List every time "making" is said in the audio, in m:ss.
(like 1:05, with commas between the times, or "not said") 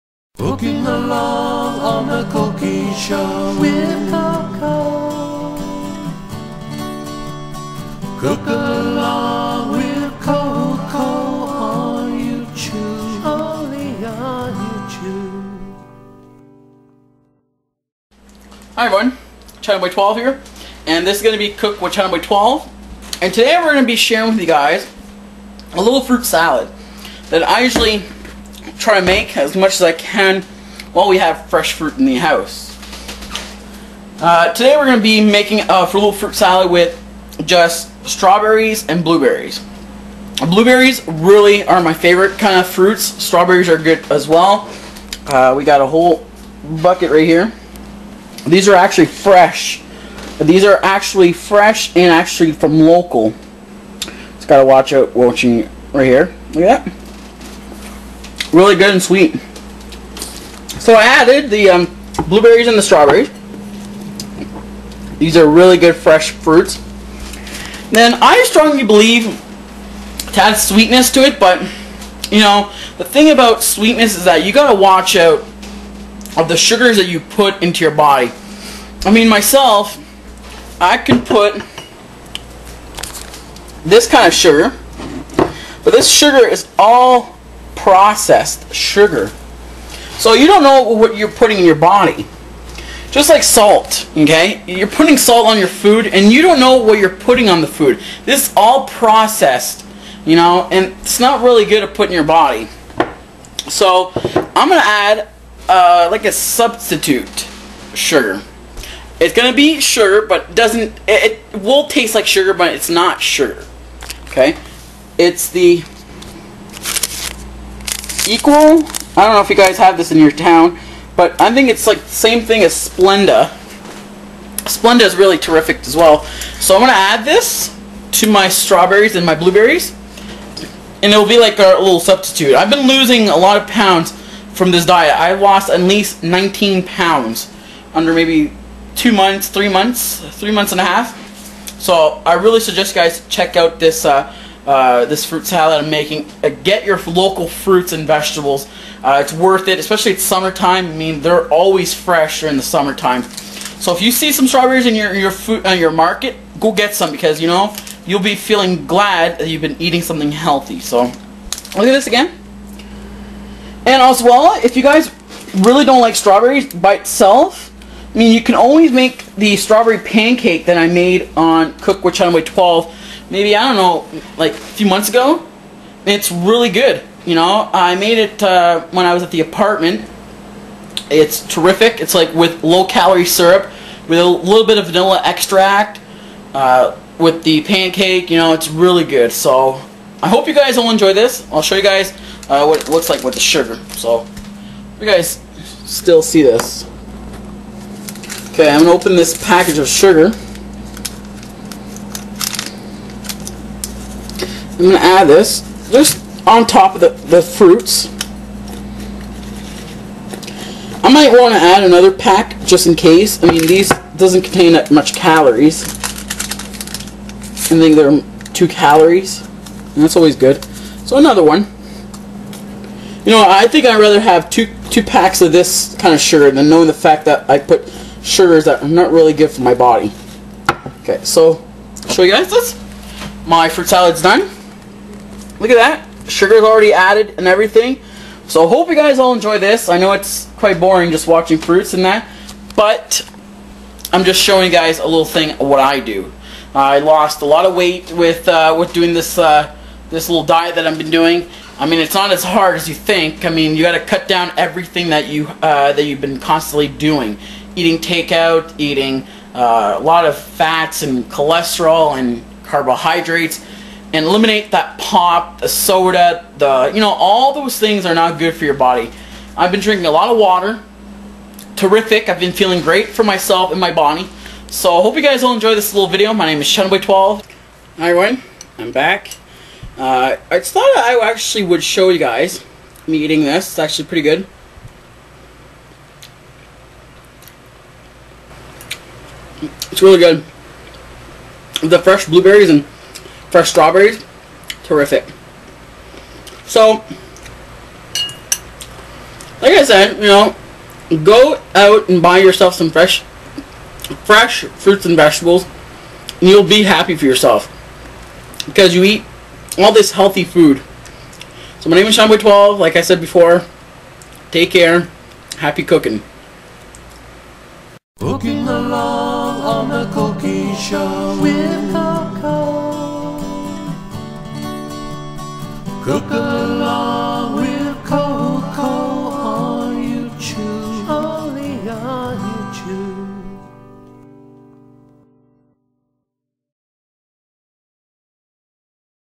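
0:35, 2:25.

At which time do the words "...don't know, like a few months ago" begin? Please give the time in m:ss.
2:53.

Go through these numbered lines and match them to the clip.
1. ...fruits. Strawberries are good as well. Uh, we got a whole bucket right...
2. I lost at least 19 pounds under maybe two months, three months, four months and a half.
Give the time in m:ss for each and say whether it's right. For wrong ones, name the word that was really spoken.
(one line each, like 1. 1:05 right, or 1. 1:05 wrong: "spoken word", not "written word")
1. 0:42 right
2. 2:15 wrong: "three", not "four".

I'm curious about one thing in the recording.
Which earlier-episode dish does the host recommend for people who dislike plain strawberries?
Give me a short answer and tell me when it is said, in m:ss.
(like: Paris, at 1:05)
strawberry pancake, at 2:49.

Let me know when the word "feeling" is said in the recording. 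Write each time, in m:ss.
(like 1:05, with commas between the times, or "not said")
2:38, 4:32.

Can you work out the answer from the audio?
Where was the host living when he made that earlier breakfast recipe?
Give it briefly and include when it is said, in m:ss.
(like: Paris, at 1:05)
the apartment, at 2:59.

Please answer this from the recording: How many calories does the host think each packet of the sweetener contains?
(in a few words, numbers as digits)
2 calories.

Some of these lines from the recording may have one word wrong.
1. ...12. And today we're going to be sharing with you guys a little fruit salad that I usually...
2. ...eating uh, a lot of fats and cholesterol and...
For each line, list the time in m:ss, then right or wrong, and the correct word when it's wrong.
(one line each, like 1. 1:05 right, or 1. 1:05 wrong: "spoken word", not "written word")
1. 0:22 right
2. 4:18 right.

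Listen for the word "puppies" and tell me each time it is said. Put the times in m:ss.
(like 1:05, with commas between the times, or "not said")
not said.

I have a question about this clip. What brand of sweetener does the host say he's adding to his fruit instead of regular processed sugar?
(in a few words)
Equal.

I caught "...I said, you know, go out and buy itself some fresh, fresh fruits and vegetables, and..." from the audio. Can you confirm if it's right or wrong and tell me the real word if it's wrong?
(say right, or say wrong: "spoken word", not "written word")
wrong: "yourself", not "itself".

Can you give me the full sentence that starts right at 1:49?
It's going to be sugar, but doesn't it, it will taste like sugar, but it's not sugar.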